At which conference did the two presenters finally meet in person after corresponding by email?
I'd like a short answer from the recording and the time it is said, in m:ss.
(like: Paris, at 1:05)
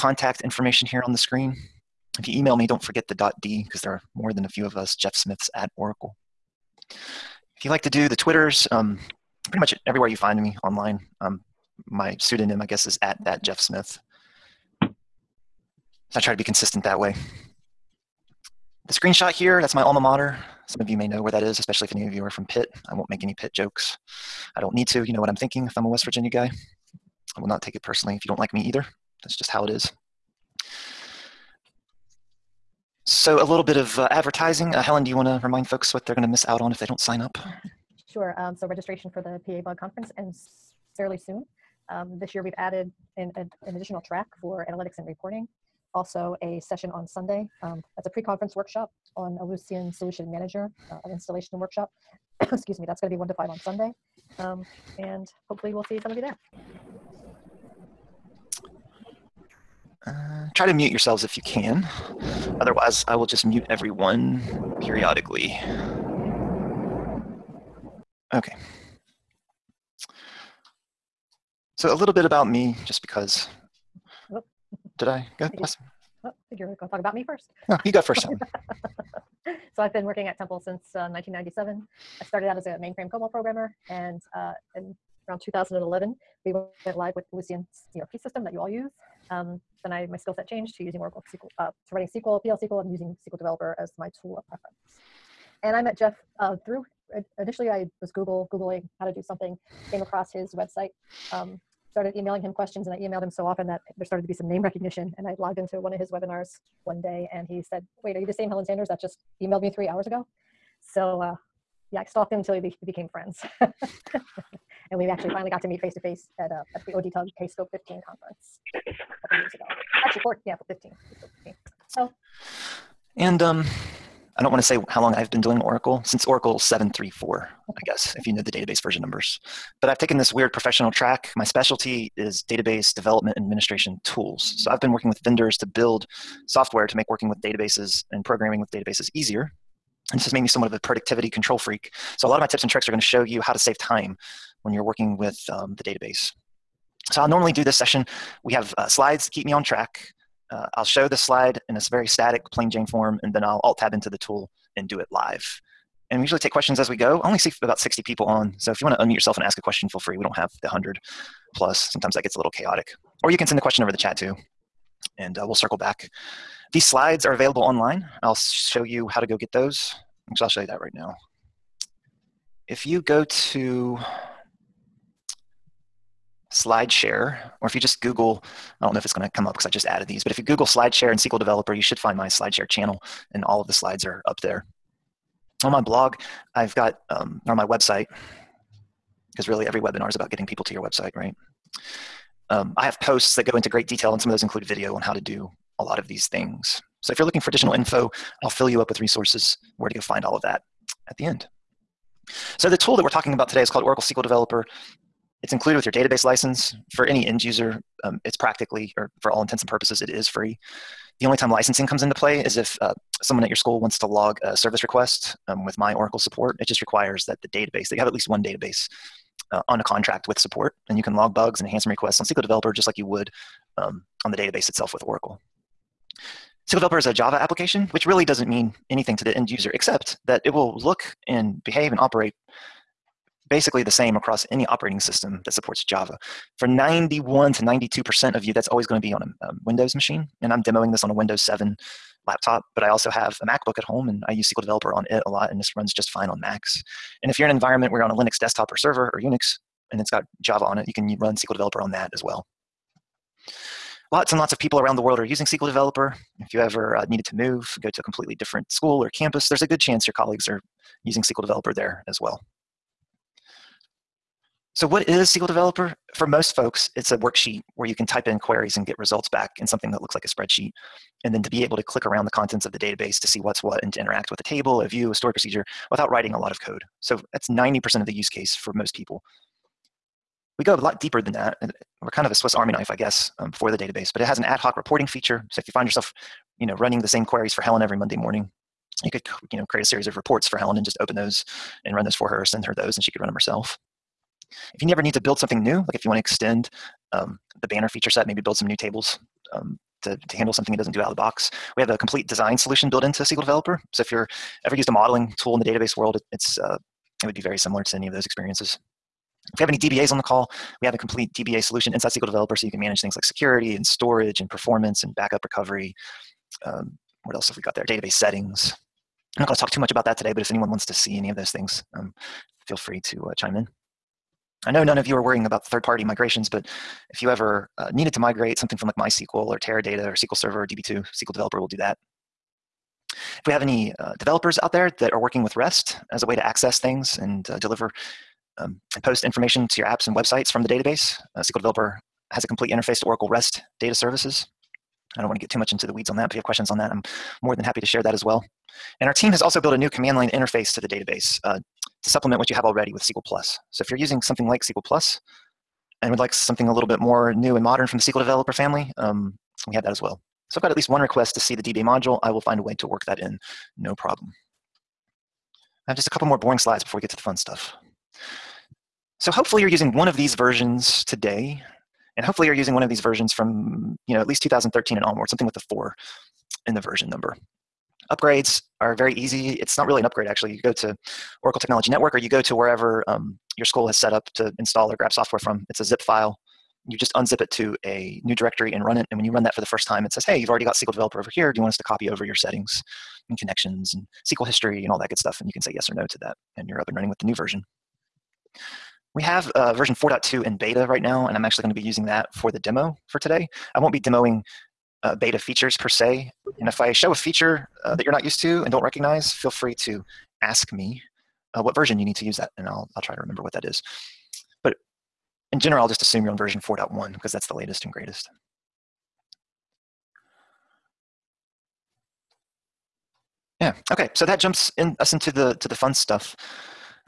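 ODTUG Kscope 15, at 1:56.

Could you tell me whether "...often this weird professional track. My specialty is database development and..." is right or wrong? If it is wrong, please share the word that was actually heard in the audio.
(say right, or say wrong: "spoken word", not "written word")
wrong: "taken", not "often".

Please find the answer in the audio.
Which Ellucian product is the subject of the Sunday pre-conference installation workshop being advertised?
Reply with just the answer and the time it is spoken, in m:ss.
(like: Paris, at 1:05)
Ellucian Solution Manager, at 0:49.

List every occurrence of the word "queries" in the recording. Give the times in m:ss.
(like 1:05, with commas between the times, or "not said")
4:28, 4:47.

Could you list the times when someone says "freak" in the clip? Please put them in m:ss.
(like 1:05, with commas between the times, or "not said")
2:21.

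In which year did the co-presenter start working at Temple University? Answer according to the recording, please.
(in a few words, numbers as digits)
1997.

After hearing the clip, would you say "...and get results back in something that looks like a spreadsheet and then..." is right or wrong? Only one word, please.
right.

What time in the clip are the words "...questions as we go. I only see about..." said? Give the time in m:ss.
2:36.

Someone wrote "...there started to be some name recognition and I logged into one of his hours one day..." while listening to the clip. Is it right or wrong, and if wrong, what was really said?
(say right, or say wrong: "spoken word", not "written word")
wrong: "webinars", not "hours".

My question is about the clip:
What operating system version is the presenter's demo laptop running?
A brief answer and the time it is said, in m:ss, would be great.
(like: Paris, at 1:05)
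Windows 7, at 4:01.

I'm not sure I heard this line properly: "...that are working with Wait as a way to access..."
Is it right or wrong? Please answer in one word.
wrong.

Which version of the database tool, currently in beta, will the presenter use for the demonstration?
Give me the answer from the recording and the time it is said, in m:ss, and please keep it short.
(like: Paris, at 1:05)
4.2, at 6:39.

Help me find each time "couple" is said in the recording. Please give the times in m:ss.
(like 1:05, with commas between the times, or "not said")
1:59, 6:06.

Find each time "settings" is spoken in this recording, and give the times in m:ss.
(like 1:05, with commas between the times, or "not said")
5:18, 6:32.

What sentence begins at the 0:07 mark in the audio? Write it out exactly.
If you like to do the Twitters, um, pretty much everywhere you find me online.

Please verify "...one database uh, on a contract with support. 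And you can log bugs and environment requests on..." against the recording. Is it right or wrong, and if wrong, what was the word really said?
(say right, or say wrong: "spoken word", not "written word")
wrong: "enhancement", not "environment".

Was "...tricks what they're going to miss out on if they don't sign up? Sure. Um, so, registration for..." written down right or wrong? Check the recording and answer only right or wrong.
wrong.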